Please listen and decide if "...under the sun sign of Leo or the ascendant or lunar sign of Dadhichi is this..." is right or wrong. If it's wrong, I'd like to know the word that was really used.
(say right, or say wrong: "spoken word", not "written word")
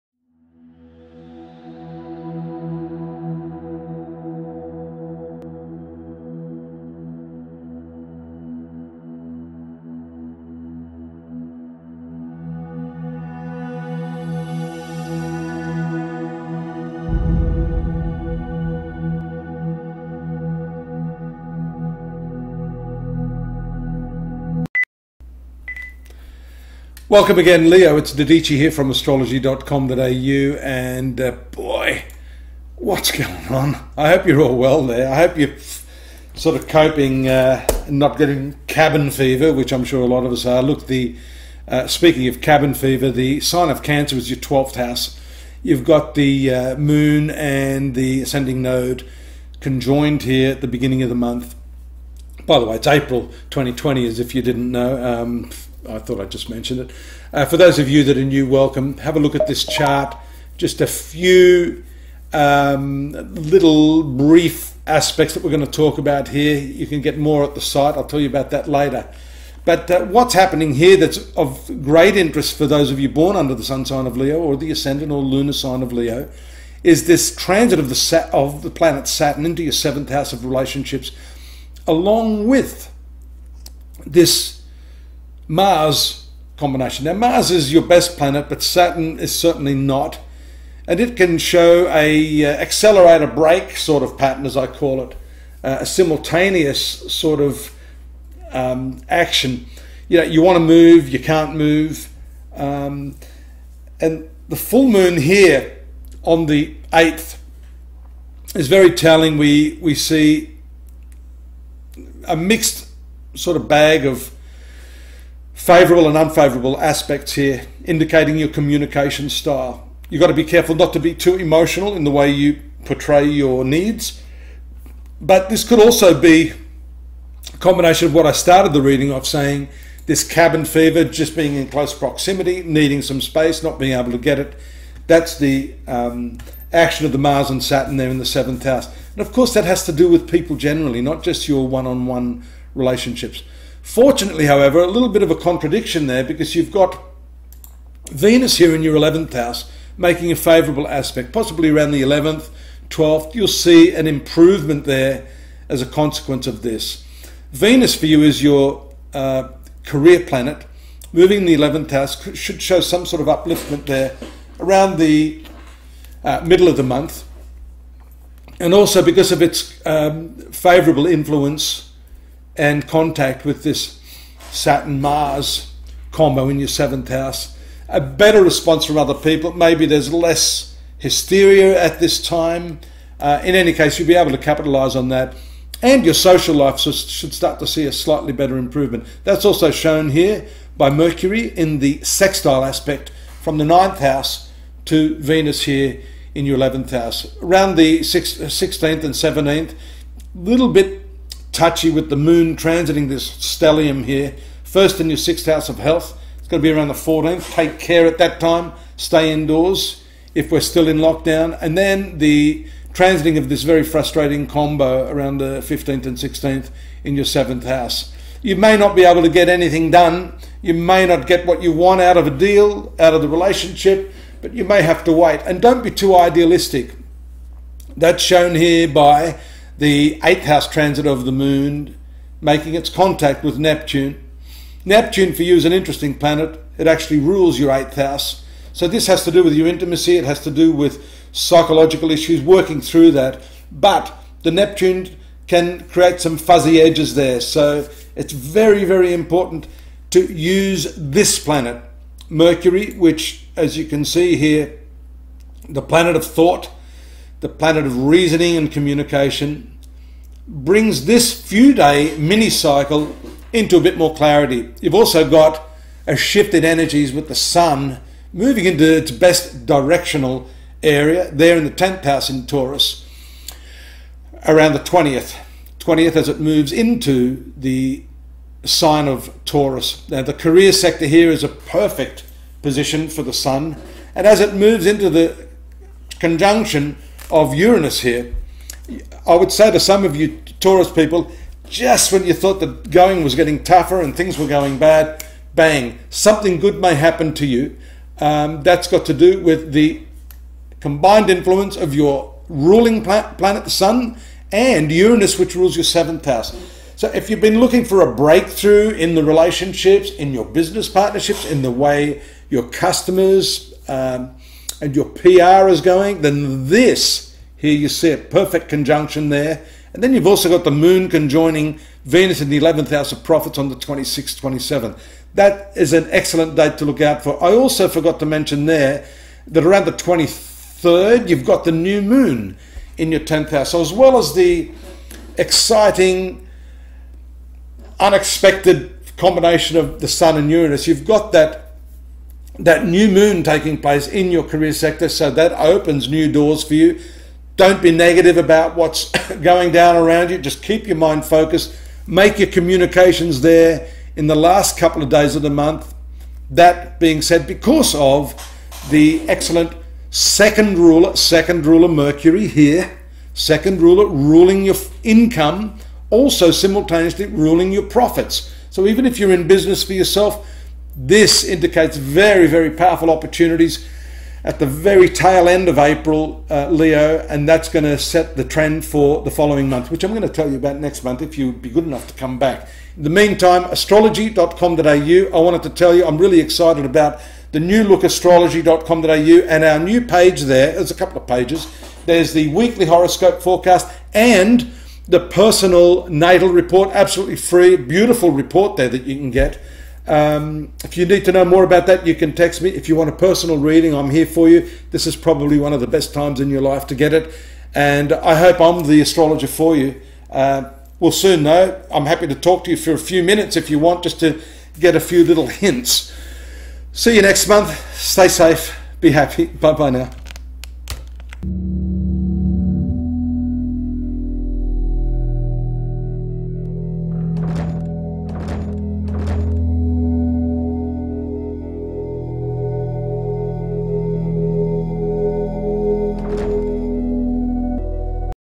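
wrong: "Leo", not "Dadhichi".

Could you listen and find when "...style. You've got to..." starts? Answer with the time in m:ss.
1:59.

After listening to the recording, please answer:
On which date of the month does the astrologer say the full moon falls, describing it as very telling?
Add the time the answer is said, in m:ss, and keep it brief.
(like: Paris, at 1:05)
8th, at 1:46.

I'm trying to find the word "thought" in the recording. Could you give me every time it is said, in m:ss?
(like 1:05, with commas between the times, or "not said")
0:55, 4:16, 4:52.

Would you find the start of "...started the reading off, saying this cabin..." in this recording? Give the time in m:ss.
2:08.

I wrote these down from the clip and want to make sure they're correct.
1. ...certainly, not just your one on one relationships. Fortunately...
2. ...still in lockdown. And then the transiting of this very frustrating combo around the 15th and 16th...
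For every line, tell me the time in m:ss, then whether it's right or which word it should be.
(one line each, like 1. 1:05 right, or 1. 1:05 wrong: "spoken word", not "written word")
1. 2:20 wrong: "generally", not "certainly"
2. 3:30 right.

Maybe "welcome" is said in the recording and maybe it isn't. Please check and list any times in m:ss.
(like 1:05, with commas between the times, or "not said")
0:27, 0:58.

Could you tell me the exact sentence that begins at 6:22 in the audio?
In the meantime, astrology.com.au, I wanted to tell you I'm really excited about the new look astrology.com.au and our new page there.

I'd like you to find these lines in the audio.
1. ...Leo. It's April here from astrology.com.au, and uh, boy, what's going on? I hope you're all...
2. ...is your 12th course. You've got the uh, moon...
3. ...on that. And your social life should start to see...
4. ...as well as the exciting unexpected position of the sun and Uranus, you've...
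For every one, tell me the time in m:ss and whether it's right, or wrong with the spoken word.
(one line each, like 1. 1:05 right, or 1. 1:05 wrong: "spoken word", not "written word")
1. 0:27 wrong: "Dadhichi", not "April"
2. 0:44 wrong: "house", not "course"
3. 3:04 right
4. 5:33 wrong: "combination", not "position".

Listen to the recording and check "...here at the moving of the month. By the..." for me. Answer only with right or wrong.
wrong.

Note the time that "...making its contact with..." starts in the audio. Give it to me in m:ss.
3:52.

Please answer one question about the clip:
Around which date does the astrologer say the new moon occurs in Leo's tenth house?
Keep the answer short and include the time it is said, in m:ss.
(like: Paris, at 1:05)
23rd, at 5:29.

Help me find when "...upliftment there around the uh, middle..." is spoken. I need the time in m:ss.
2:43.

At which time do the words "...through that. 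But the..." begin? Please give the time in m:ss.
4:02.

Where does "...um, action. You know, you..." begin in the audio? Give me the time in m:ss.
1:38.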